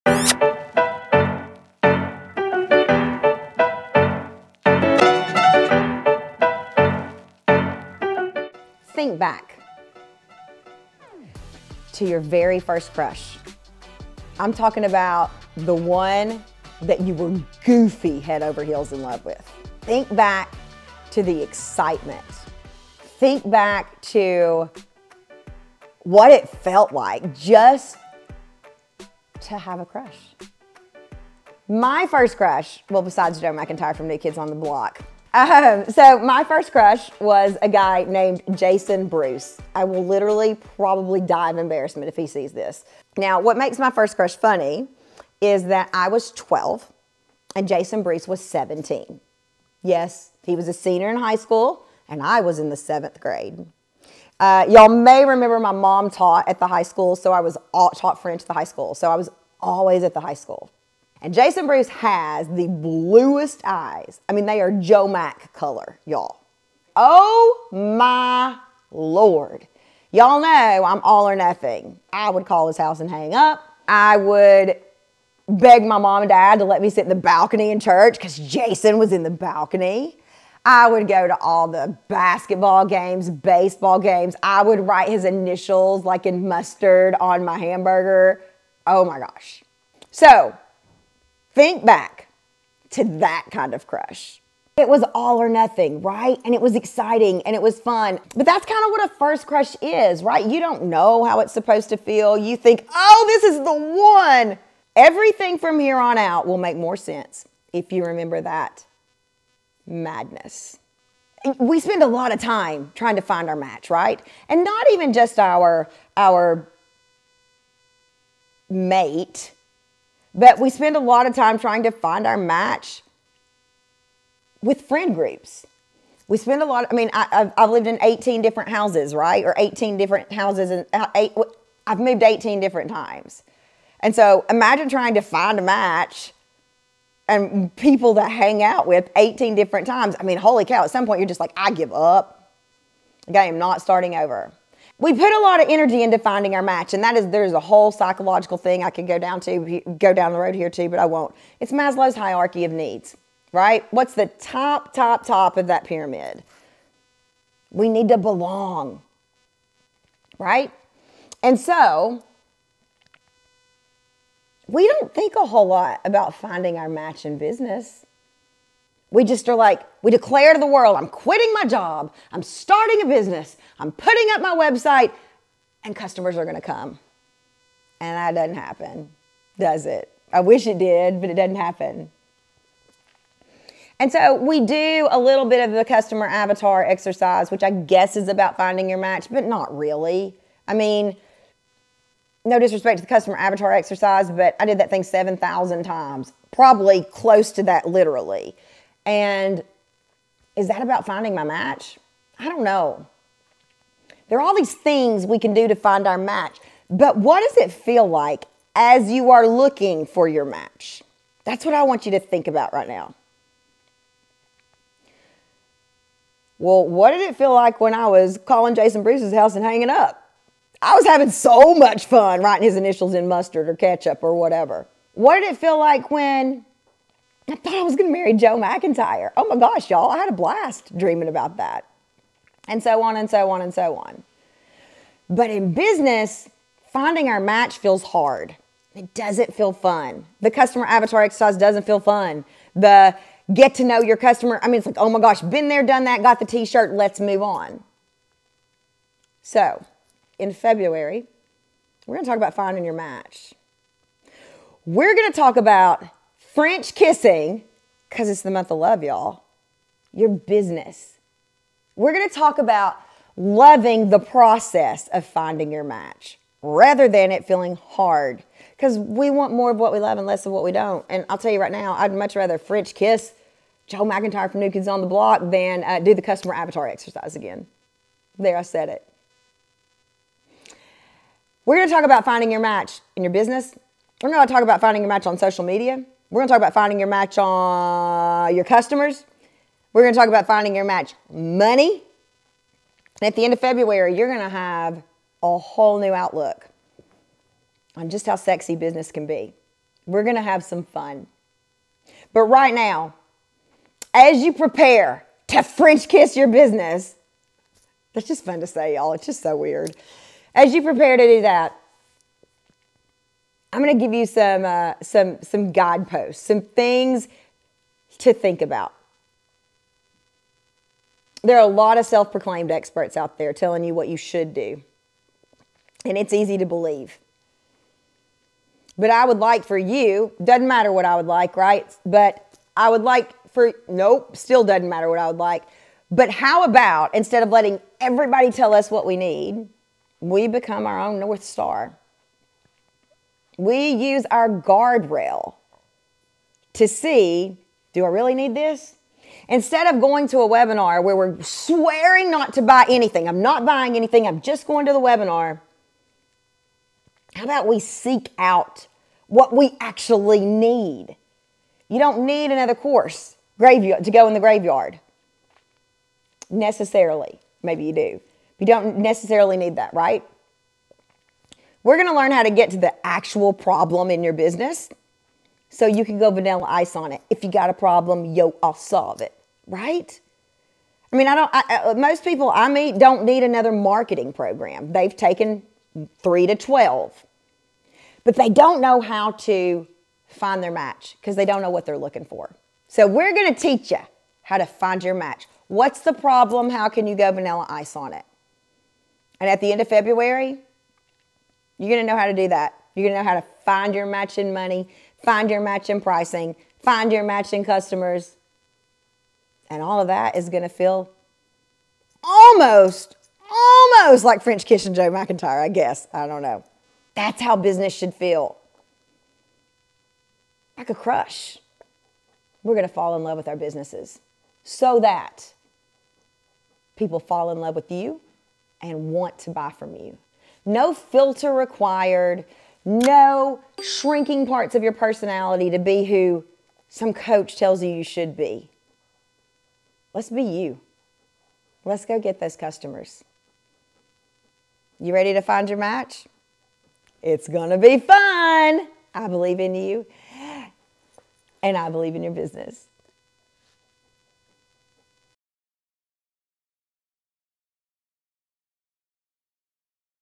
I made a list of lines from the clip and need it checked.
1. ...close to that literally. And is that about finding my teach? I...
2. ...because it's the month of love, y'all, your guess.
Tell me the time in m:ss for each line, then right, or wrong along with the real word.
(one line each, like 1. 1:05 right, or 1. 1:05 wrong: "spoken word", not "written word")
1. 3:17 wrong: "match", not "teach"
2. 4:18 wrong: "business", not "guess".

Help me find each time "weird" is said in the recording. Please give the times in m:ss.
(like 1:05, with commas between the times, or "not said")
5:09.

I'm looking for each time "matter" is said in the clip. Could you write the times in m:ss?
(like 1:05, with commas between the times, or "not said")
5:30, 5:34.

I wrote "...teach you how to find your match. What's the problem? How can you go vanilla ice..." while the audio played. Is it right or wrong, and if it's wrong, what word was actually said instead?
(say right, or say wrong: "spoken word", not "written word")
right.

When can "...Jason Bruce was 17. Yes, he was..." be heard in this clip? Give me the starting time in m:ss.
0:47.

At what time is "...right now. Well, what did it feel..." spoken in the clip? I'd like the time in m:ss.
3:32.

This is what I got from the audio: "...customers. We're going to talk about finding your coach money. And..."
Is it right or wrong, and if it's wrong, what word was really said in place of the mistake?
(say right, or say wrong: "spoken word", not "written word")
wrong: "match", not "coach".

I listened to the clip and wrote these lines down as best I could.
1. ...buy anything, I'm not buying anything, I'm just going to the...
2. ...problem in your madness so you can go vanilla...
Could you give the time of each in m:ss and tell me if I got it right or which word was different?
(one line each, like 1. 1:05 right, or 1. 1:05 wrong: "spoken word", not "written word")
1. 5:52 right
2. 6:13 wrong: "business", not "madness".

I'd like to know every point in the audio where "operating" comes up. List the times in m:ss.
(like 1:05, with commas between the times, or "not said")
not said.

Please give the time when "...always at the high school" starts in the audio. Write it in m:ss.
0:59.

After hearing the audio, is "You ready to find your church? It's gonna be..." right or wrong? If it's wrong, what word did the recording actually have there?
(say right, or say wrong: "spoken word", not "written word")
wrong: "match", not "church".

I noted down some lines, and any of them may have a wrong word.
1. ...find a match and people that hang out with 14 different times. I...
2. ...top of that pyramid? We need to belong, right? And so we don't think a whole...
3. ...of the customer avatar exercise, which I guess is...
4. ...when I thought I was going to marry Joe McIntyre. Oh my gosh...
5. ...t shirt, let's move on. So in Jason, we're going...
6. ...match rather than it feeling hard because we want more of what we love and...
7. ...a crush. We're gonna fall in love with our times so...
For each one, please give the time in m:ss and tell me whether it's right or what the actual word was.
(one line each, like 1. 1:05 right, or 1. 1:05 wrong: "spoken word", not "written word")
1. 2:15 wrong: "18", not "14"
2. 2:35 right
3. 3:05 right
4. 3:46 right
5. 4:06 wrong: "February", not "Jason"
6. 4:25 right
7. 7:00 wrong: "businesses", not "times".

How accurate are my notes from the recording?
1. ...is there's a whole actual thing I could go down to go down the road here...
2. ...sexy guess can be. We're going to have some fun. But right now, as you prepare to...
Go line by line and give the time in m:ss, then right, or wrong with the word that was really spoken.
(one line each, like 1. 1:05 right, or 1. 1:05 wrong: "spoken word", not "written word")
1. 2:27 wrong: "psychological", not "actual"
2. 4:58 wrong: "business", not "guess".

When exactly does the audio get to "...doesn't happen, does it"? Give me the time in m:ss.
2:58.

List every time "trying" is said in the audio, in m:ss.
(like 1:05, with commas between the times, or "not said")
1:52, 2:01, 2:14.